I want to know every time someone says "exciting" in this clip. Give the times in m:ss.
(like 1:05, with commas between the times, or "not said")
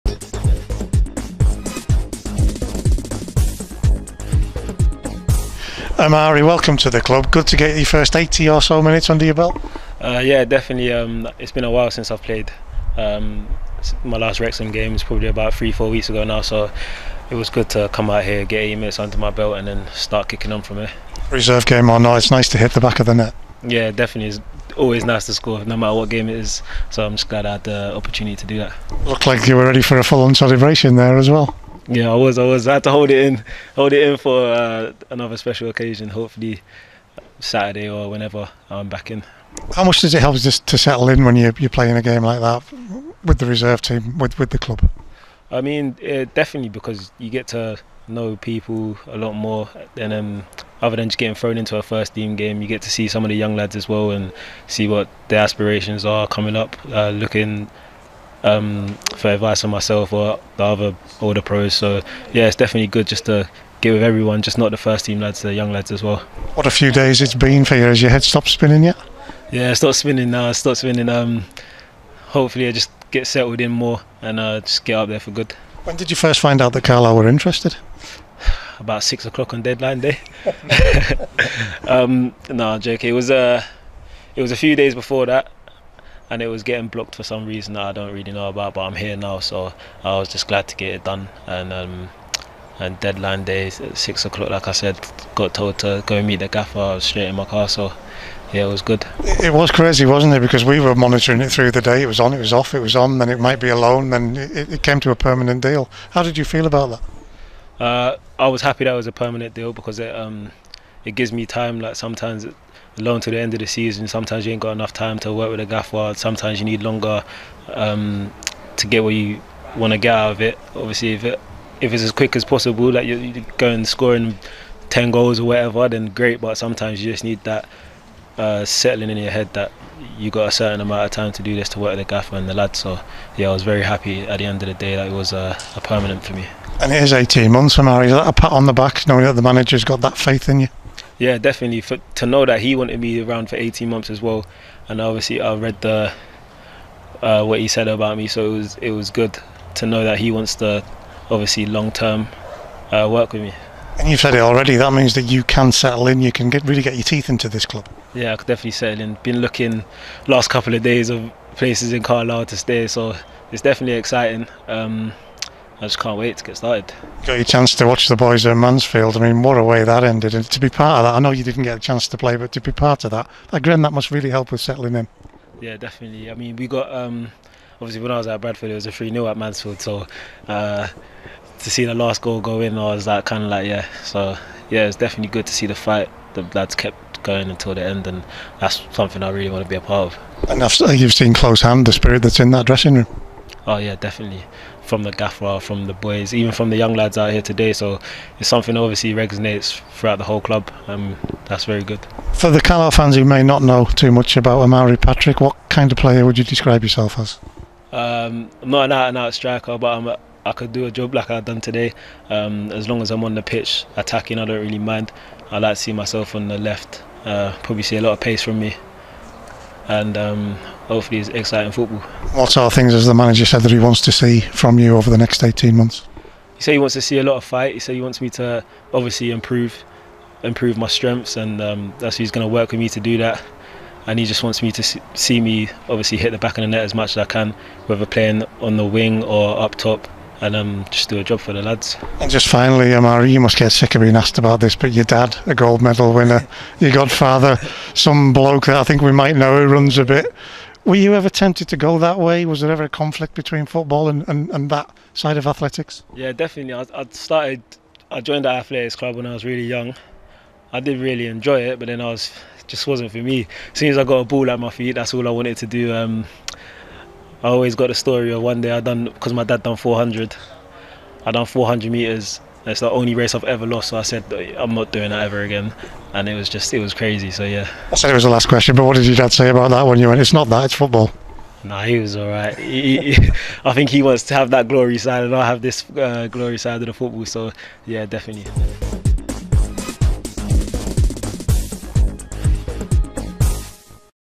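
2:43, 3:41.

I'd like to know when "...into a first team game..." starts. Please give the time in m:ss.
0:51.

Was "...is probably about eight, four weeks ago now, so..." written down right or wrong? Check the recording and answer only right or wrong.
wrong.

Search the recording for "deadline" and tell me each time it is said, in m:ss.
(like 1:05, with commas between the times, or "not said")
1:19, 1:33.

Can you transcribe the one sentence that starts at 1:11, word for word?
Um, hopefully, I just get settled in more and uh, just get up there for good.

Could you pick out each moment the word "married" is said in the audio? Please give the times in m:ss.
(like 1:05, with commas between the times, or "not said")
not said.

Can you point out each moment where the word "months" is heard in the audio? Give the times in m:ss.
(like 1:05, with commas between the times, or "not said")
2:17, 2:23, 3:45.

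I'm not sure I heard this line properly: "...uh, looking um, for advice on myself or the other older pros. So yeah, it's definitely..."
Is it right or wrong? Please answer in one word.
right.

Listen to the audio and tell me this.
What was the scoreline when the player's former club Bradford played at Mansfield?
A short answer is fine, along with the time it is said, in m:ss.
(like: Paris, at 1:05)
3-0, at 2:58.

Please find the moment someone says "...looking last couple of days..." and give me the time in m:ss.
2:39.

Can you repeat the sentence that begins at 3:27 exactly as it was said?
Um, I'm not an out and out striker, but I'm a, I could do a job like I've done today.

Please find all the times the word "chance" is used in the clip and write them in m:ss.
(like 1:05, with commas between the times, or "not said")
2:47, 2:51.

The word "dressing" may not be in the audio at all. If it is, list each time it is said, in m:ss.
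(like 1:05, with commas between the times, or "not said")
3:12.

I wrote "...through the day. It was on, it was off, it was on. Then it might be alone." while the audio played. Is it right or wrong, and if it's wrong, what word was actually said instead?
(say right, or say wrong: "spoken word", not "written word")
right.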